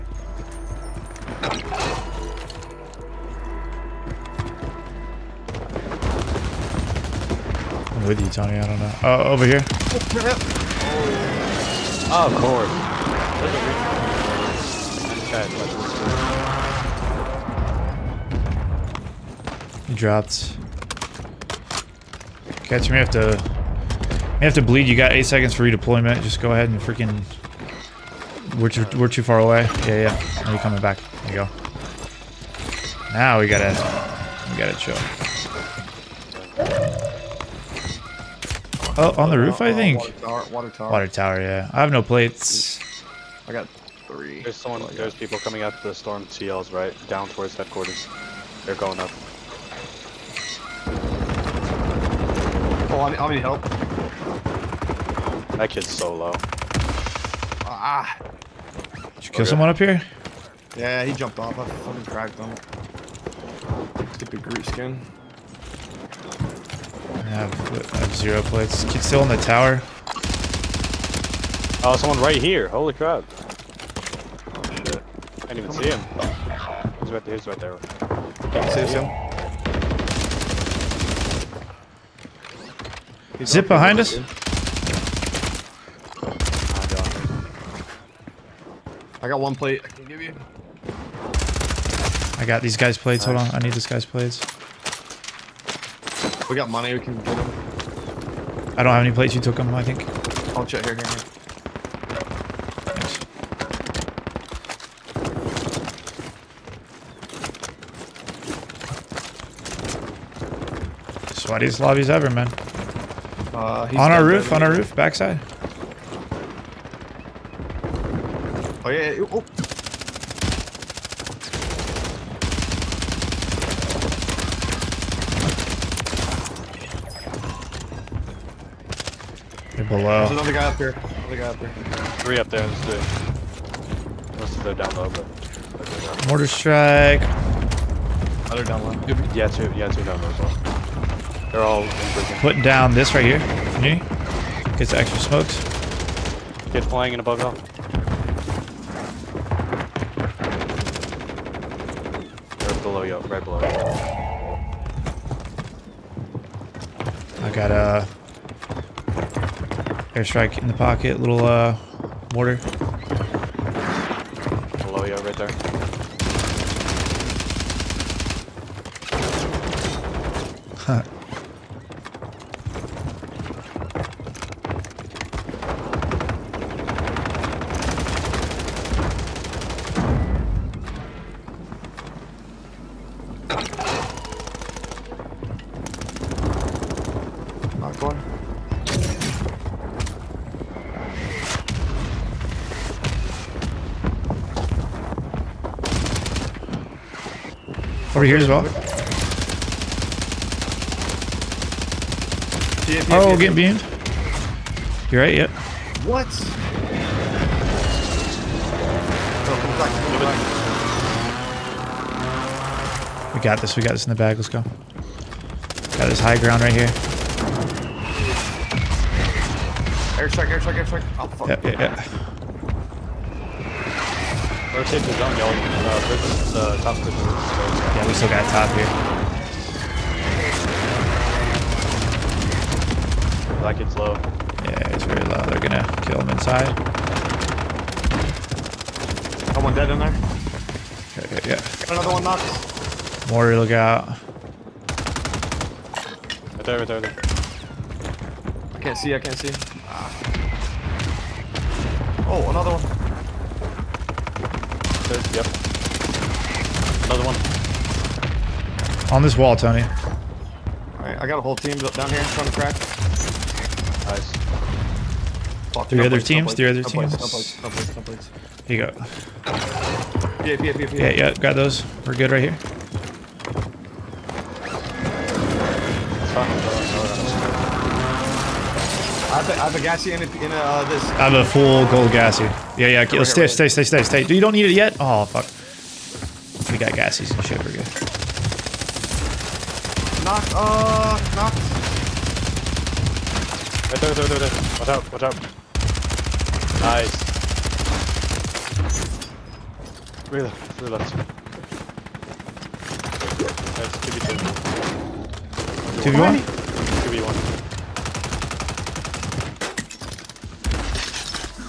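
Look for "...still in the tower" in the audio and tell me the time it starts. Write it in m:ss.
1:09.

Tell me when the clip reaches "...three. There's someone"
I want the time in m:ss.
0:44.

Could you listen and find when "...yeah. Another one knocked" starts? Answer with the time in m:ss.
4:01.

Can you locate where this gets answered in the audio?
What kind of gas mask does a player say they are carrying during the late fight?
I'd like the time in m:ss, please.
4:41.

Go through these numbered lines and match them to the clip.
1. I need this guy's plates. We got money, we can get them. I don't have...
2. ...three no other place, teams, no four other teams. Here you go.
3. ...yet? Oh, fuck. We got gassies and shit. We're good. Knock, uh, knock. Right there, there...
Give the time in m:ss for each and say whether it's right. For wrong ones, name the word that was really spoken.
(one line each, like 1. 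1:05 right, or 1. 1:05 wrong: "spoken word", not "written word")
1. 1:33 right
2. 4:25 wrong: "three", not "four"
3. 4:44 right.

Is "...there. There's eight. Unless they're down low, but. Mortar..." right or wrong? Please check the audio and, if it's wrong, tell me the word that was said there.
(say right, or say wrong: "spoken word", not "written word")
wrong: "two", not "eight".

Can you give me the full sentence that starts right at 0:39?
Oh, on the roof, uh, I think.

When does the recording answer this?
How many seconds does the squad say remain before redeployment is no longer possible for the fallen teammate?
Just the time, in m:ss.
0:25.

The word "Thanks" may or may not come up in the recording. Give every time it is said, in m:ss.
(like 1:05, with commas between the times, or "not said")
1:42.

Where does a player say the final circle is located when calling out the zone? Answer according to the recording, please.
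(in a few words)
Top prison.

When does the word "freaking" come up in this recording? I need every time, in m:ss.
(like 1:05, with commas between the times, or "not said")
0:26.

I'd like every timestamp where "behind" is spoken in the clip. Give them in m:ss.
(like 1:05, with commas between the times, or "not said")
1:23.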